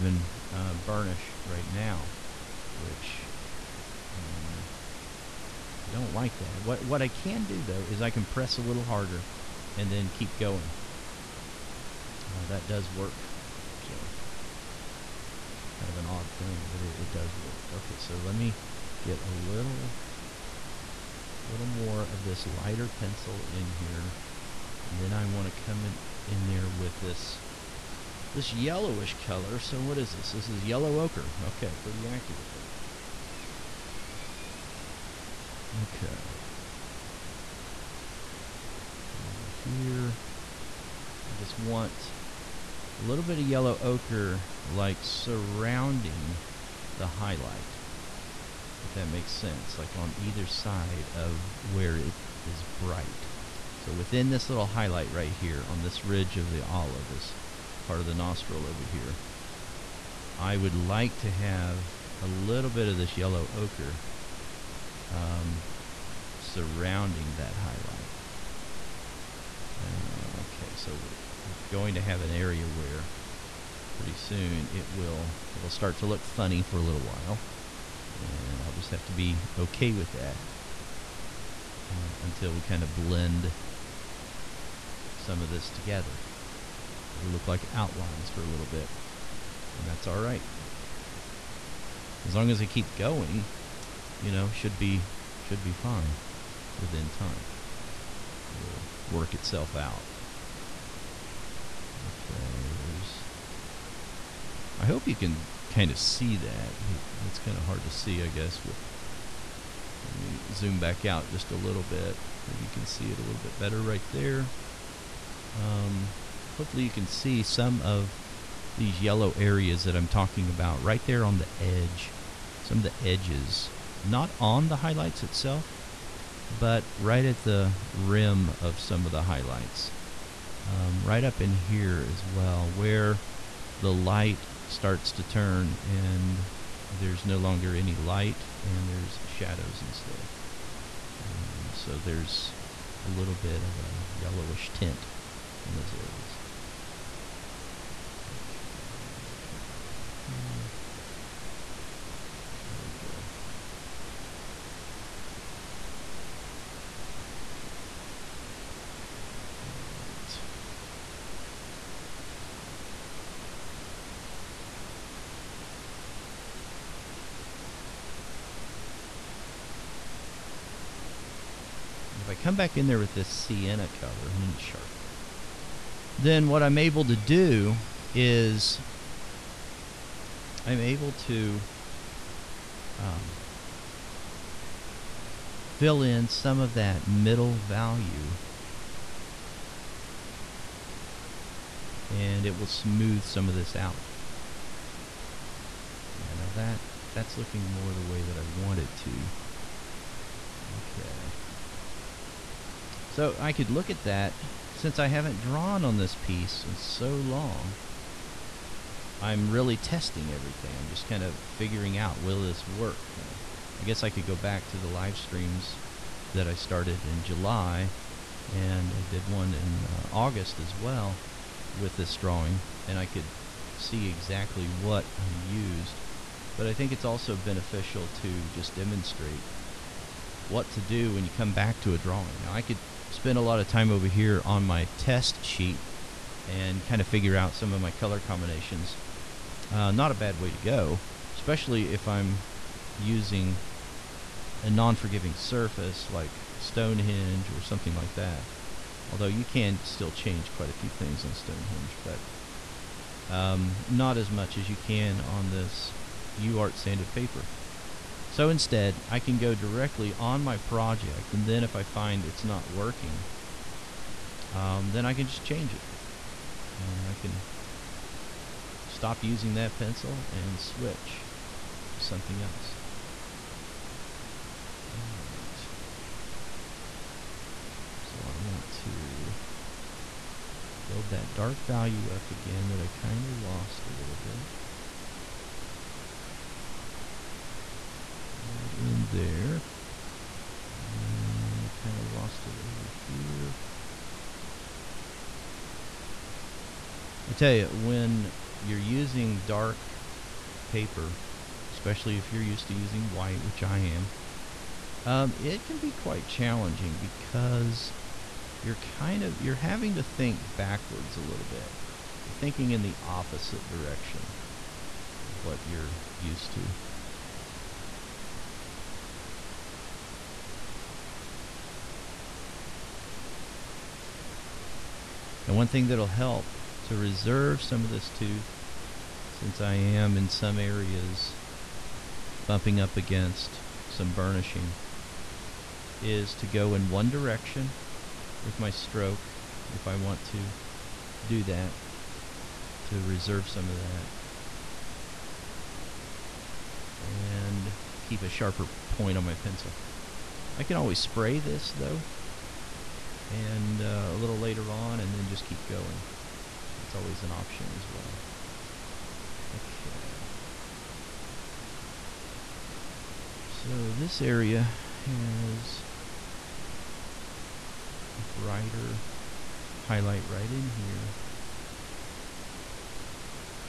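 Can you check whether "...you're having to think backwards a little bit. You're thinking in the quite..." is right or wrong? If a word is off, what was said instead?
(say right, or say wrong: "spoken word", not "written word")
wrong: "opposite", not "quite".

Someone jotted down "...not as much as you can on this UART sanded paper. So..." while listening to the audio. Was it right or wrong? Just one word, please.
right.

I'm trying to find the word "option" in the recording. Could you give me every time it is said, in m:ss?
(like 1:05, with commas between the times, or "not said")
5:57.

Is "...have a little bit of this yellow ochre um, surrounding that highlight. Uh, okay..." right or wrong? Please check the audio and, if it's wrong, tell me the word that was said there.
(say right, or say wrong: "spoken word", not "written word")
right.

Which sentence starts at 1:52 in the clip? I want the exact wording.
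Maybe you can see it a little bit better right there.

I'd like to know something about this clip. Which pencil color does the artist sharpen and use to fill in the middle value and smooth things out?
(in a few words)
Sienna.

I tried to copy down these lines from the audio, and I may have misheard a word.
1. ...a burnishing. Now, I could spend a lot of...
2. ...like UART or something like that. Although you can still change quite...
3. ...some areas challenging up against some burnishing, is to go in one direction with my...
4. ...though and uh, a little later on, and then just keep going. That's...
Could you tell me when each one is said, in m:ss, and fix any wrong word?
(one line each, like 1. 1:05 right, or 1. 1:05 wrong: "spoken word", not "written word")
1. 3:51 wrong: "drawing", not "burnishing"
2. 4:06 wrong: "Stonehenge", not "UART"
3. 5:30 wrong: "bumping", not "challenging"
4. 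5:51 right.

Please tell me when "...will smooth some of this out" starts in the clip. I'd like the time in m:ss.
3:12.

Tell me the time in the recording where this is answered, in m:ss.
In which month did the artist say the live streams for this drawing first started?
3:37.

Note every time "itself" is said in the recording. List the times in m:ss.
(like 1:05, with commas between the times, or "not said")
1:39, 2:05.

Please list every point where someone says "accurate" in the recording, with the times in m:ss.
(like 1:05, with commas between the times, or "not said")
0:32.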